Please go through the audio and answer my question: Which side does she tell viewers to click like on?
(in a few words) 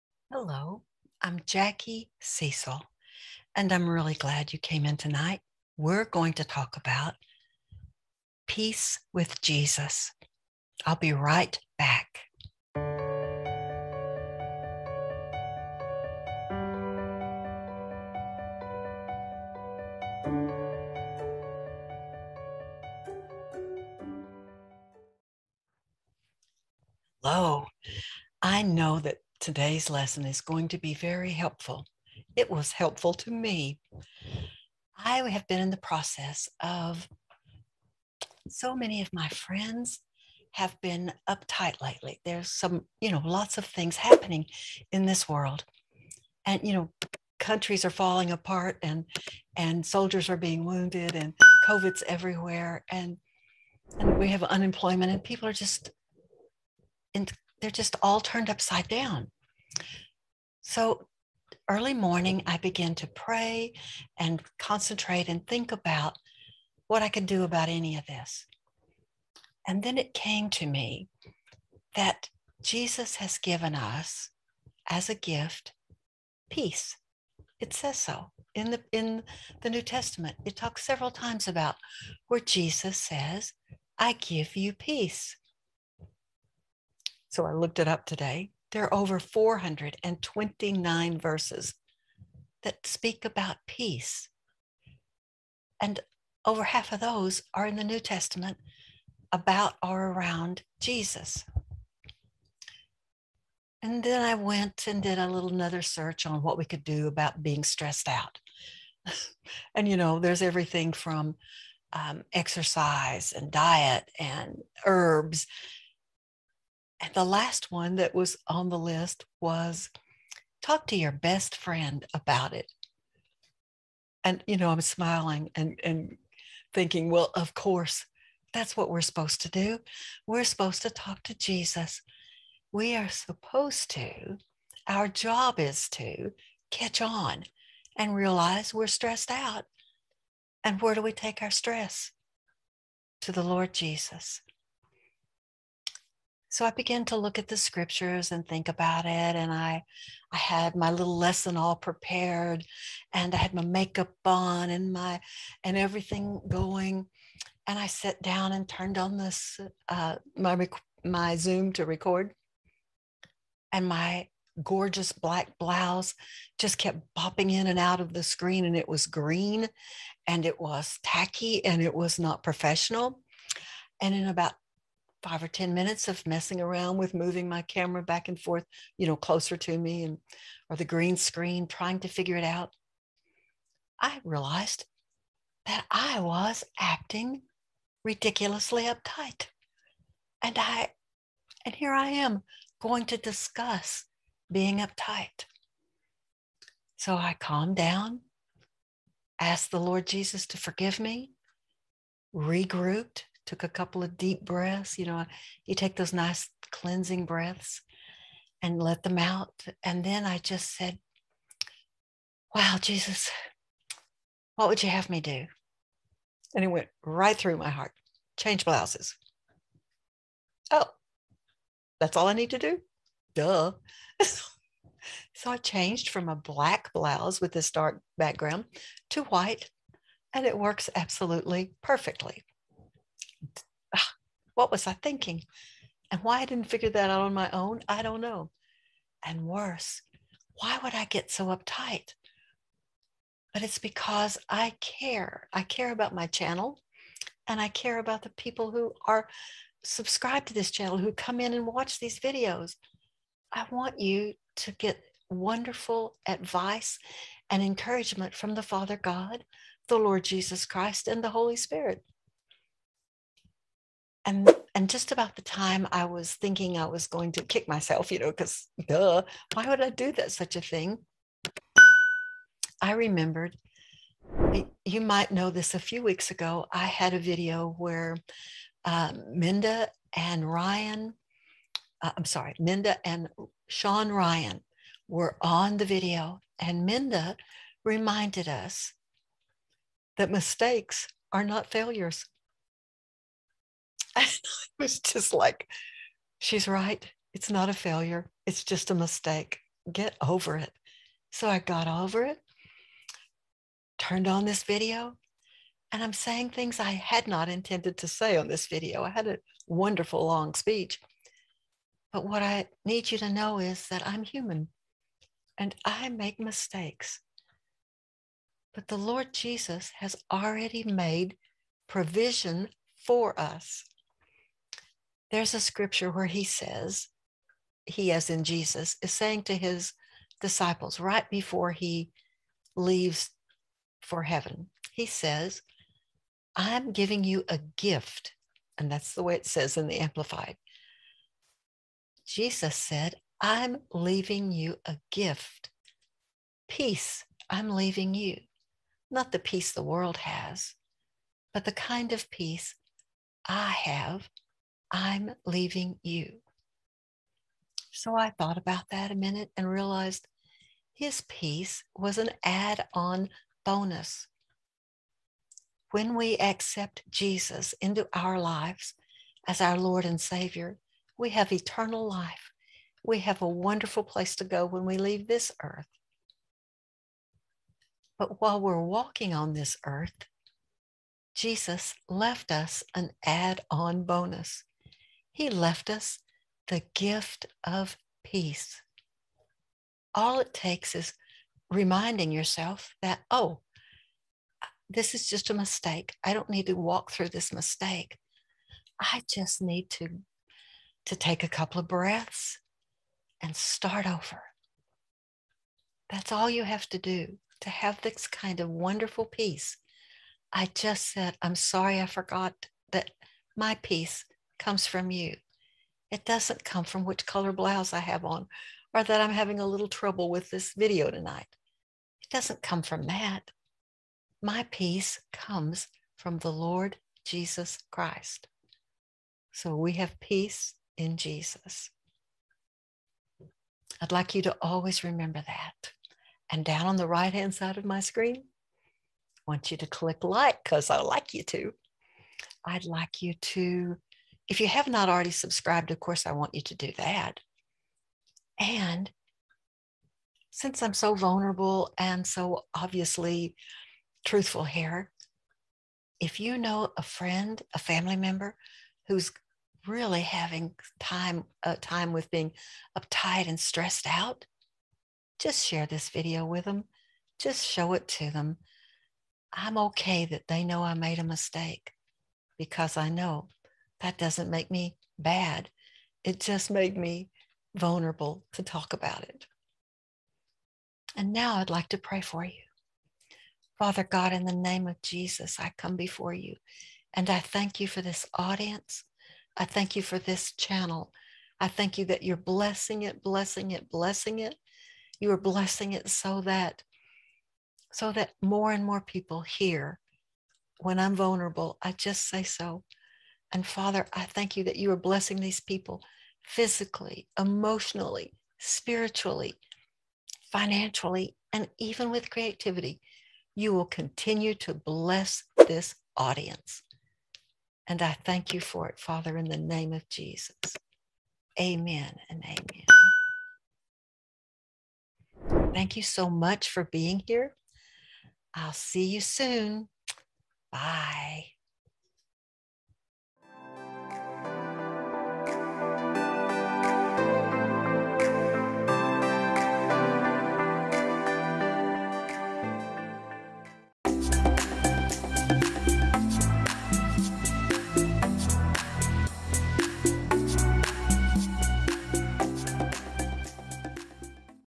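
Right hand side.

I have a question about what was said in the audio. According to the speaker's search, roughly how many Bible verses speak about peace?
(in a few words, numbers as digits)
429.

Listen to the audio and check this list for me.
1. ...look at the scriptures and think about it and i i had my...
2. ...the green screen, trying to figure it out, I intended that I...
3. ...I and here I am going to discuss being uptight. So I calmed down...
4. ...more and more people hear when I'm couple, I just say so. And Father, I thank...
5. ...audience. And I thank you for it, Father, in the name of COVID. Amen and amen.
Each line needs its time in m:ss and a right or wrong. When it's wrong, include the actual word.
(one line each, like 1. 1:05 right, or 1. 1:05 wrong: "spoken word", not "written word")
1. 2:27 right
2. 3:00 wrong: "realized", not "intended"
3. 3:10 right
4. 8:18 wrong: "vulnerable", not "couple"
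5. 8:36 wrong: "Jesus", not "COVID".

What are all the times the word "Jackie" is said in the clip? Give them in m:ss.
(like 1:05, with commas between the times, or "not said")
0:01.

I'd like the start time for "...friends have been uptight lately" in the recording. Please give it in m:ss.
0:39.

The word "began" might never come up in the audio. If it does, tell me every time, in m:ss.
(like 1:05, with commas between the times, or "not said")
1:02, 2:26.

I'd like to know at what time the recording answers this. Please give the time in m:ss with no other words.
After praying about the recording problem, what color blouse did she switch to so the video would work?
3:49.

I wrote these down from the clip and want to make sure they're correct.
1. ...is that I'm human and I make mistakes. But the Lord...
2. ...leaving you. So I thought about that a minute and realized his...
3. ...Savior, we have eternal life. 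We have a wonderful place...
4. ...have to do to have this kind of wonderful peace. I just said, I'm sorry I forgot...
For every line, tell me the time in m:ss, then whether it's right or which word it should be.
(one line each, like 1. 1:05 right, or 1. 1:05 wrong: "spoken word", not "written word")
1. 5:13 right
2. 5:55 right
3. 6:10 right
4. 6:46 right.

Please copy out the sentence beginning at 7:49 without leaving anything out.
I'm okay that they know I made a mistake because I know that doesn't make me bad.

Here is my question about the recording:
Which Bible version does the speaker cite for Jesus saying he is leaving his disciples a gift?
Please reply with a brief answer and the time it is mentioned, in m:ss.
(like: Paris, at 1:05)
Amplified, at 5:39.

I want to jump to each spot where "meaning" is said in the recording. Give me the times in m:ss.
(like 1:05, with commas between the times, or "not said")
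not said.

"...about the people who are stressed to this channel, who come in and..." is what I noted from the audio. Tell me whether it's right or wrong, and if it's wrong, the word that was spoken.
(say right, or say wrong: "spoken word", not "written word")
wrong: "subscribed", not "stressed".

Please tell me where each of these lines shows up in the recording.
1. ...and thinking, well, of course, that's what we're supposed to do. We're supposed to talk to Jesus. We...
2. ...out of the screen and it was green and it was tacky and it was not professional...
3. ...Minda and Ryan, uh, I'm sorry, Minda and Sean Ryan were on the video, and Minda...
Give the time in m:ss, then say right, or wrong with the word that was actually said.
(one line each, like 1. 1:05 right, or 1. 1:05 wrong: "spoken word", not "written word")
1. 2:05 right
2. 2:47 right
3. 4:39 right.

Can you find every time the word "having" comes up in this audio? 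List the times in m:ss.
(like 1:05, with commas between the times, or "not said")
6:59, 7:40.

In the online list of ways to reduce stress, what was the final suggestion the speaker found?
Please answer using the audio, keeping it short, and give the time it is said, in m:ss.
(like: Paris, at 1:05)
Talk to your best friend, at 2:00.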